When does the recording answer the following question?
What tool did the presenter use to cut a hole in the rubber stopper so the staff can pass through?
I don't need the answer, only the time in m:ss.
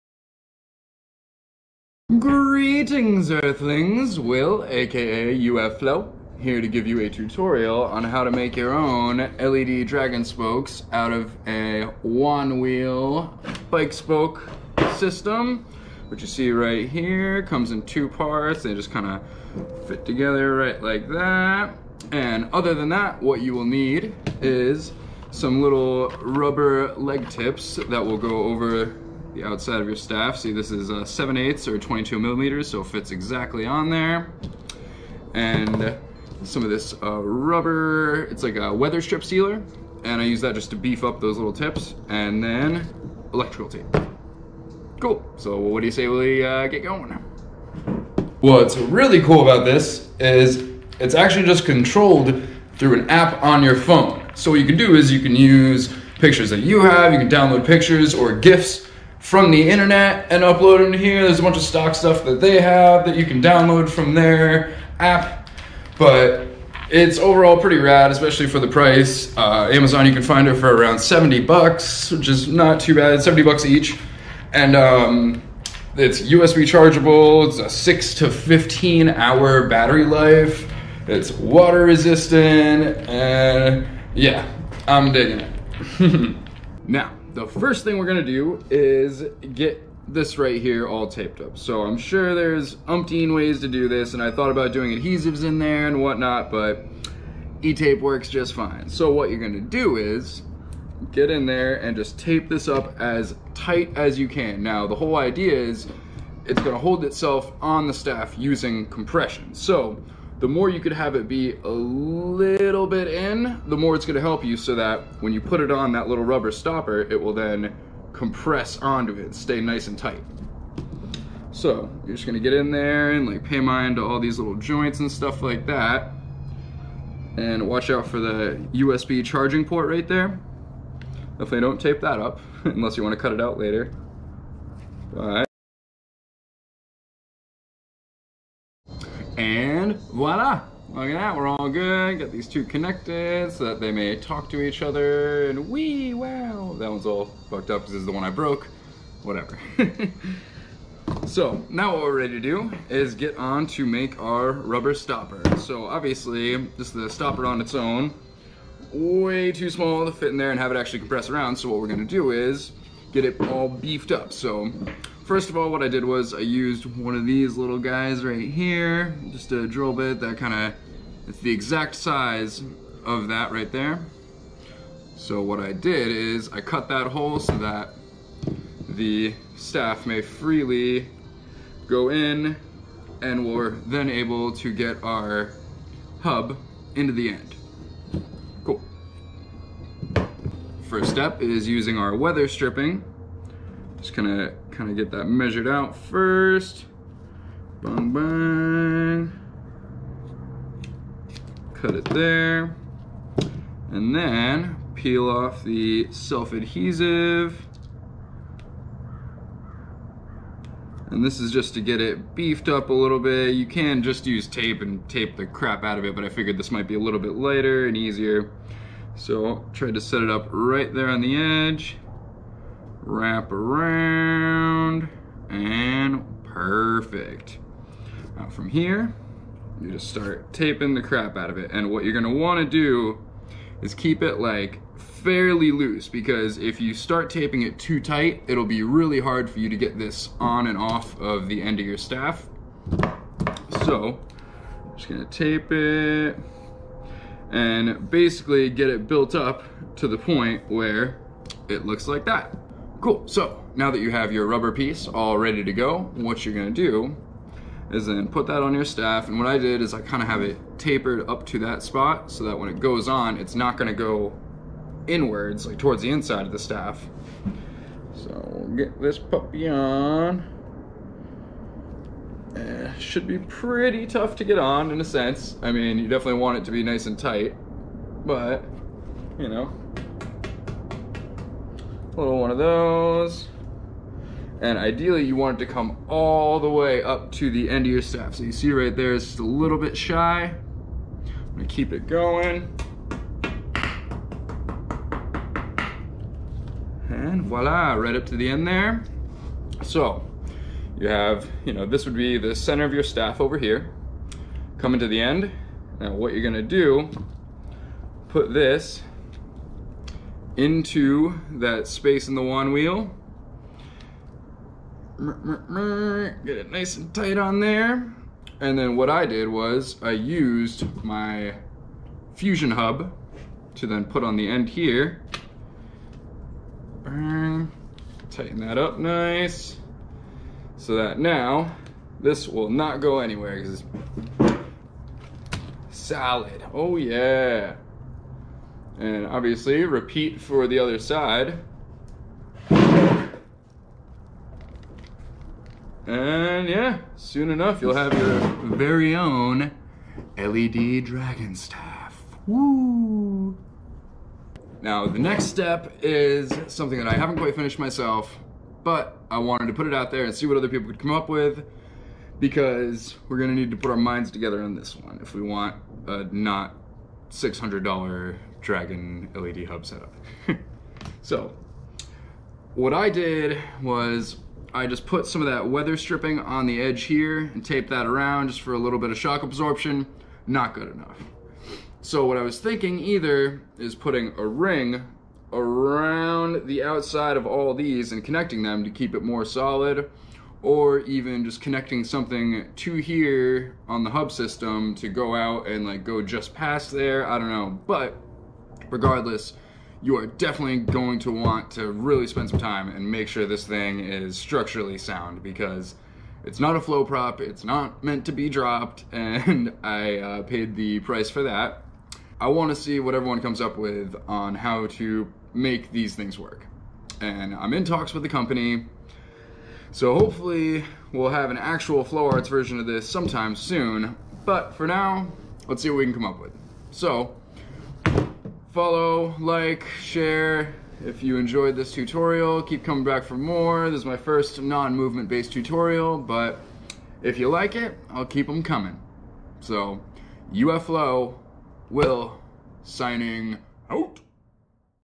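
2:49.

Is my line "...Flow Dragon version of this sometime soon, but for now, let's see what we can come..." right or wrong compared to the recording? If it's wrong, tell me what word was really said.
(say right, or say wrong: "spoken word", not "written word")
wrong: "Arts", not "Dragon".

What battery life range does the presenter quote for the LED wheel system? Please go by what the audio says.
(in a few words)
6 to 15 hours.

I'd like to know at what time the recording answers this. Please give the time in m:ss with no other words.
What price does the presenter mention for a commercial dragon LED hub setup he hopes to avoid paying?
6:07.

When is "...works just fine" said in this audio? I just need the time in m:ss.
1:38.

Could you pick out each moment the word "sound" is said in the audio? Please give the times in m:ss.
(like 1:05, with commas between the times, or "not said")
6:44.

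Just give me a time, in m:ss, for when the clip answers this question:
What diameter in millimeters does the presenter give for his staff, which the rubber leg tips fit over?
0:31.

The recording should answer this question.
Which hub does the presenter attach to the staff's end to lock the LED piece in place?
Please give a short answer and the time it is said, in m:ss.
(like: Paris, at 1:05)
fusion hub, at 5:22.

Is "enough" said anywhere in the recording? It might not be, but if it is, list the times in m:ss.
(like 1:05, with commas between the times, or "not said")
5:47, 6:20.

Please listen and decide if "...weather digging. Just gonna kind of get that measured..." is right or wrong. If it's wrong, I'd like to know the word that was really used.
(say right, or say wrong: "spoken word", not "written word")
wrong: "stripping", not "digging".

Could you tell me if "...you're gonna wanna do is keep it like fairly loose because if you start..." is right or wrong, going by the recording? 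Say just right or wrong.
right.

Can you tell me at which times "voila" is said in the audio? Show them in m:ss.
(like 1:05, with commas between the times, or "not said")
2:20, 4:57.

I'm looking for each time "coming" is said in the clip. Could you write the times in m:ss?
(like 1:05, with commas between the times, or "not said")
5:04, 7:12, 7:18.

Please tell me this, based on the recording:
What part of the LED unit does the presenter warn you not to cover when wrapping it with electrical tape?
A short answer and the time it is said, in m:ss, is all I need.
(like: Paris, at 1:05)
USB charging port, at 2:08.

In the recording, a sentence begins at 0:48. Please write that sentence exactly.
What's really cool about this is it's actually just controlled through an app on your phone.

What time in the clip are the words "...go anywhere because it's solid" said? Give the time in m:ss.
5:33.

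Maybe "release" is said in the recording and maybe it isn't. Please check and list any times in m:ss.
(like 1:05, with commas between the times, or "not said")
not said.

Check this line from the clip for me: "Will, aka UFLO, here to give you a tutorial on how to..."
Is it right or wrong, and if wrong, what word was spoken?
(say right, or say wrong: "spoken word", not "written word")
right.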